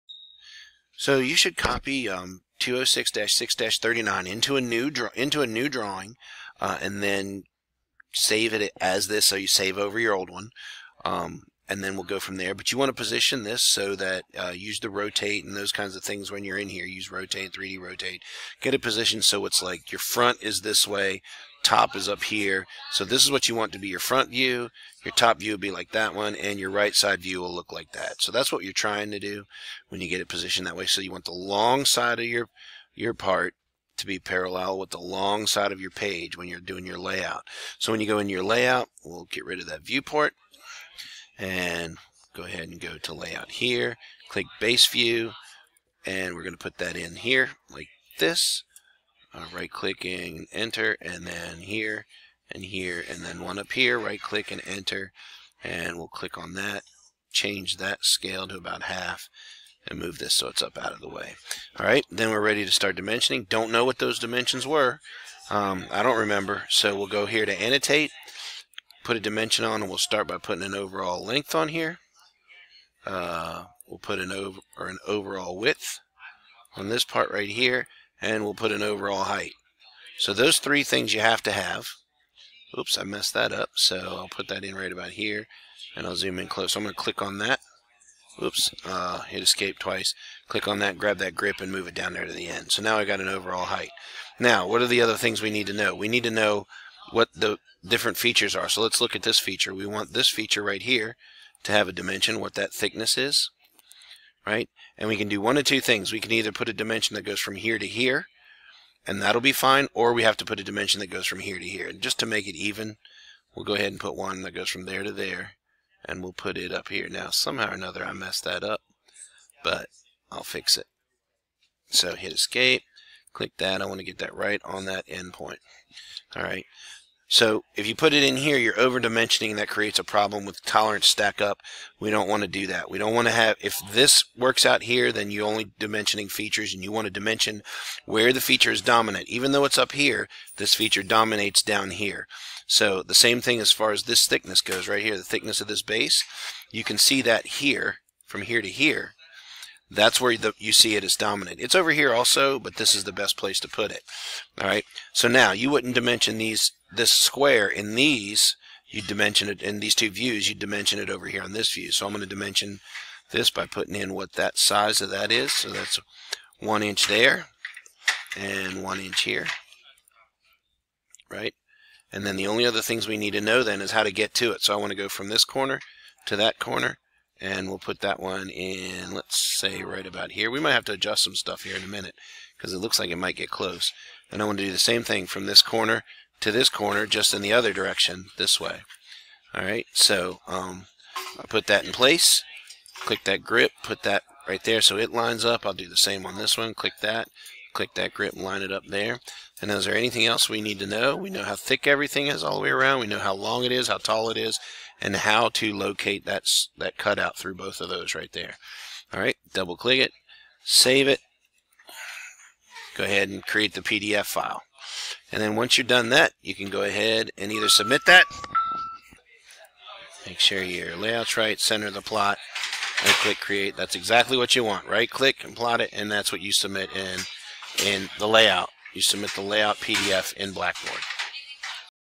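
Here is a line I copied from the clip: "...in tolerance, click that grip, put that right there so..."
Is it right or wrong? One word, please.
wrong.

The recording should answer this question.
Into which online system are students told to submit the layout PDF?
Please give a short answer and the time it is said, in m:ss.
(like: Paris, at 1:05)
Blackboard, at 3:50.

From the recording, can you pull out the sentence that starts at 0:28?
So that's what you're trying to do when you get it positioned that way.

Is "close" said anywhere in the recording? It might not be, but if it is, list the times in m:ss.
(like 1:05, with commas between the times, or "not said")
1:26, 3:03.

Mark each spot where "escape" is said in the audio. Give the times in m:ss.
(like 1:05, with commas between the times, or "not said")
1:29, 2:02.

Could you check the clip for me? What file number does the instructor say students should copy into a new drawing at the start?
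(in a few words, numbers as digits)
206-6-39.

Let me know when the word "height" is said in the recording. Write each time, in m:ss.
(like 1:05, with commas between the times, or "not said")
1:19, 1:33.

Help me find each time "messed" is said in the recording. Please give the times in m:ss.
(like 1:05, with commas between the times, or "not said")
1:23, 1:58.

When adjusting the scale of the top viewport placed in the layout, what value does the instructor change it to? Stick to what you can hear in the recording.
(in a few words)
about half.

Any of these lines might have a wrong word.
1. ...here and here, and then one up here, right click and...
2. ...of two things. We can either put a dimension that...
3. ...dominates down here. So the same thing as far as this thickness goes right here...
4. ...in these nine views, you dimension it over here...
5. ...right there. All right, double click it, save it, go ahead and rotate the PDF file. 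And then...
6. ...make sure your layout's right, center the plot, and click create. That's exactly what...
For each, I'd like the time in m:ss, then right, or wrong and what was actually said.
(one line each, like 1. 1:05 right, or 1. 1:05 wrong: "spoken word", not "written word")
1. 0:51 right
2. 1:45 right
3. 2:21 right
4. 2:39 wrong: "two", not "nine"
5. 3:28 wrong: "create", not "rotate"
6. 3:40 right.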